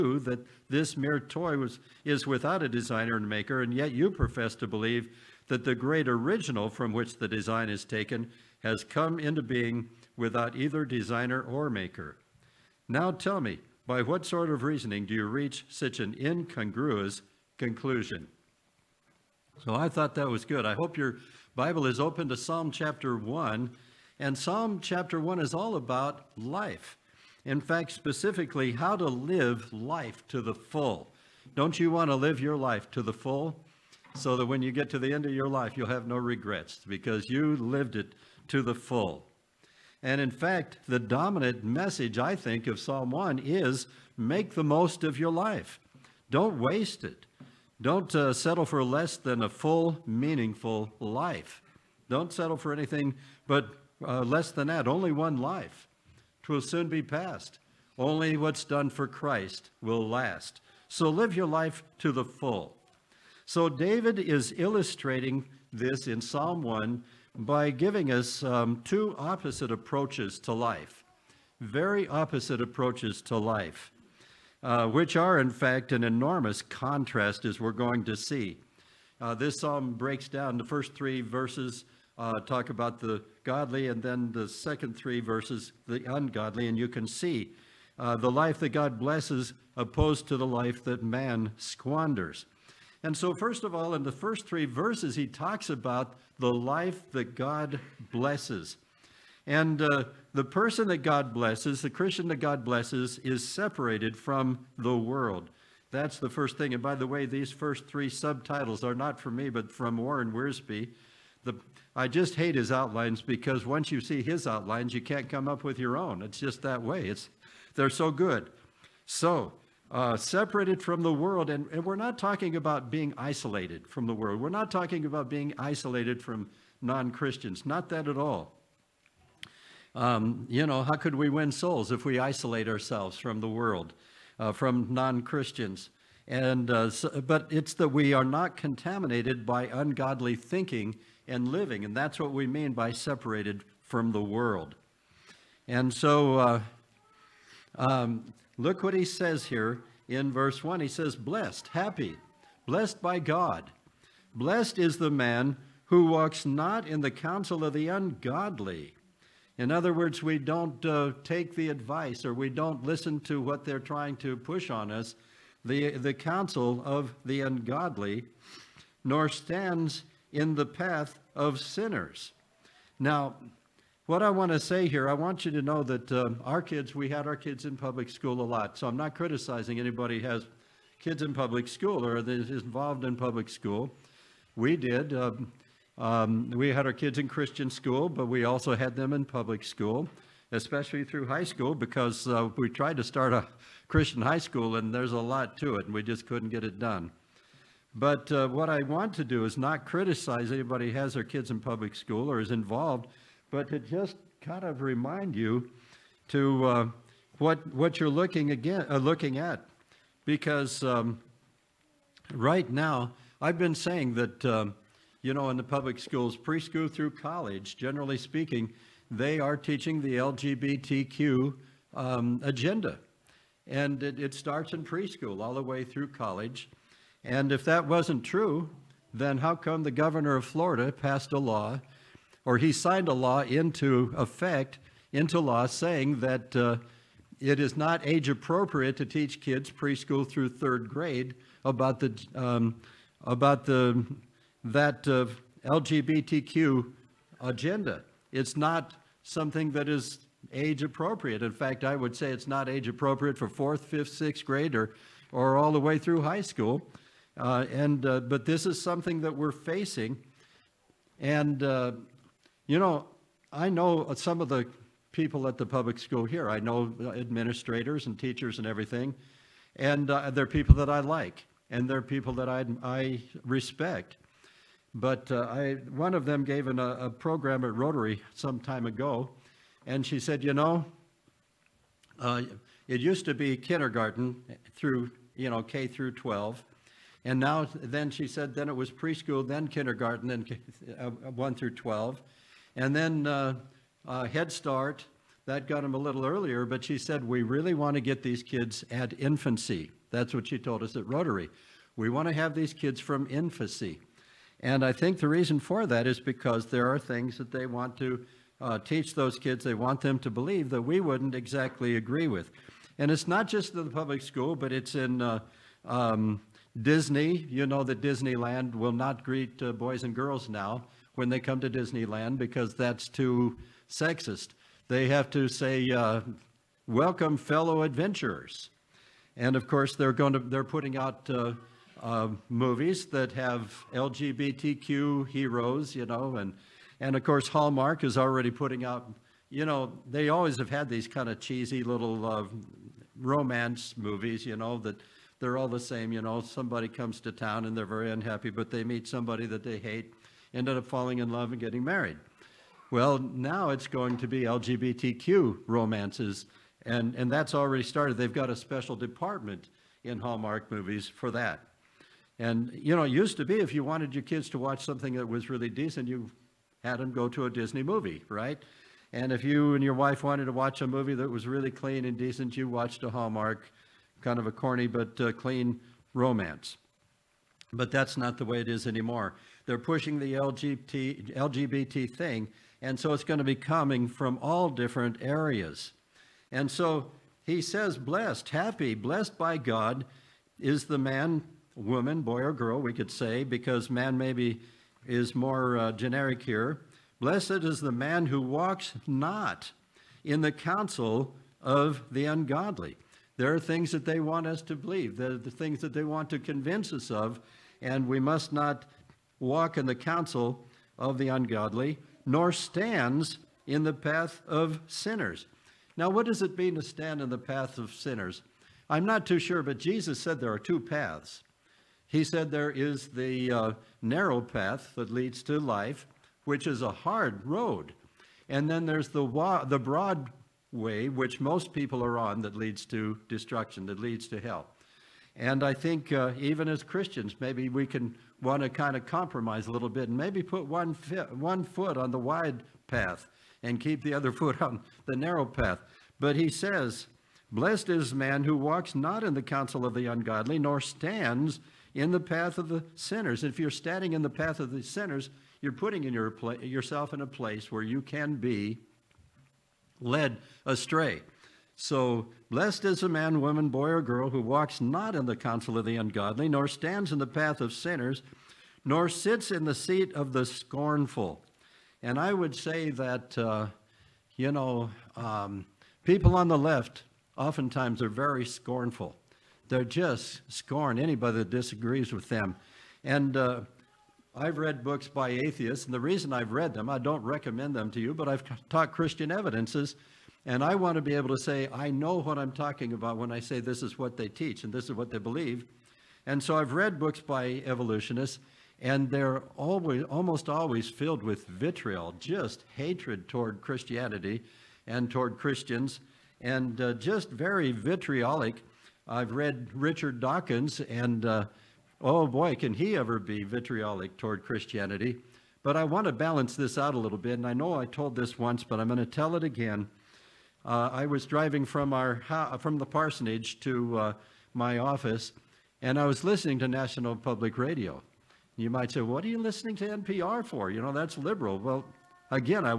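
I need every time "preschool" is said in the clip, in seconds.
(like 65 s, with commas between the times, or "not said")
216 s, 224 s, 239 s, 288 s.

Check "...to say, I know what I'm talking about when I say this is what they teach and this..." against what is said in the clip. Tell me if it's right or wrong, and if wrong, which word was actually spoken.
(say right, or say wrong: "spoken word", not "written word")
right.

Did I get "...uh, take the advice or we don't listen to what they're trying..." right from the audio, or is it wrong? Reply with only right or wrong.
right.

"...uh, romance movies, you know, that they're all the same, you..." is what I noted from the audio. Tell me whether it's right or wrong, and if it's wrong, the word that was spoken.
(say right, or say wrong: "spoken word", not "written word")
right.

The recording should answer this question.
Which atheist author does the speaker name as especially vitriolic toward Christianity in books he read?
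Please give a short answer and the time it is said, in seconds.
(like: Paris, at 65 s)
Richard Dawkins, at 509 s.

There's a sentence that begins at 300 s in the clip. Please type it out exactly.
That's what she told us at Rotary.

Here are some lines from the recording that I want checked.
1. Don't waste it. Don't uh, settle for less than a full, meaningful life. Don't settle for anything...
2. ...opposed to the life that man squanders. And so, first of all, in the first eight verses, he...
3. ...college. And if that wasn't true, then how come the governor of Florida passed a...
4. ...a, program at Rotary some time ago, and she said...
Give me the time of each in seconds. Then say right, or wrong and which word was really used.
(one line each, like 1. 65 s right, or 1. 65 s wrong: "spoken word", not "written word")
1. 46 s right
2. 89 s wrong: "three", not "eight"
3. 226 s right
4. 276 s right.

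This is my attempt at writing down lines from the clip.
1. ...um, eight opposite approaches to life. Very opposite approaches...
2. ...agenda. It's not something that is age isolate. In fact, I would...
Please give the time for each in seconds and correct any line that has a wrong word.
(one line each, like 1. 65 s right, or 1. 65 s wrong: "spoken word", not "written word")
1. 68 s wrong: "two", not "eight"
2. 247 s wrong: "appropriate", not "isolate".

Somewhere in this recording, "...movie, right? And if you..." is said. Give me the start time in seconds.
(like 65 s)
367 s.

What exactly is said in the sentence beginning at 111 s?
The, I just hate his outlines because once you see his outlines, you can't come up with your own.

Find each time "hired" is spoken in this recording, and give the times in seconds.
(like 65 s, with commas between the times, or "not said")
not said.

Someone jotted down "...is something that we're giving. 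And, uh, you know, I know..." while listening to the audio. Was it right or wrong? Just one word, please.
wrong.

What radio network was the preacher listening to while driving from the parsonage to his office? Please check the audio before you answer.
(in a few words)
National Public Radio.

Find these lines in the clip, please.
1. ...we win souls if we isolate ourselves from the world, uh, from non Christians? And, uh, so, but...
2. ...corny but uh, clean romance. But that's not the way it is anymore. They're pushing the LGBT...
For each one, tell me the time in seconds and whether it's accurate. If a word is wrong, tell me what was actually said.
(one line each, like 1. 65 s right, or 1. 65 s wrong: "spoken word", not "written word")
1. 131 s right
2. 374 s right.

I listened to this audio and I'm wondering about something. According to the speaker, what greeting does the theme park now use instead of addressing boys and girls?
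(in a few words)
Welcome fellow adventurers.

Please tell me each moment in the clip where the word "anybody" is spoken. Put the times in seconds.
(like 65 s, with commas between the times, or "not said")
179 s, 200 s, 480 s.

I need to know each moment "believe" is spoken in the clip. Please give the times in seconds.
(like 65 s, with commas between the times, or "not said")
4 s, 310 s, 404 s, 495 s.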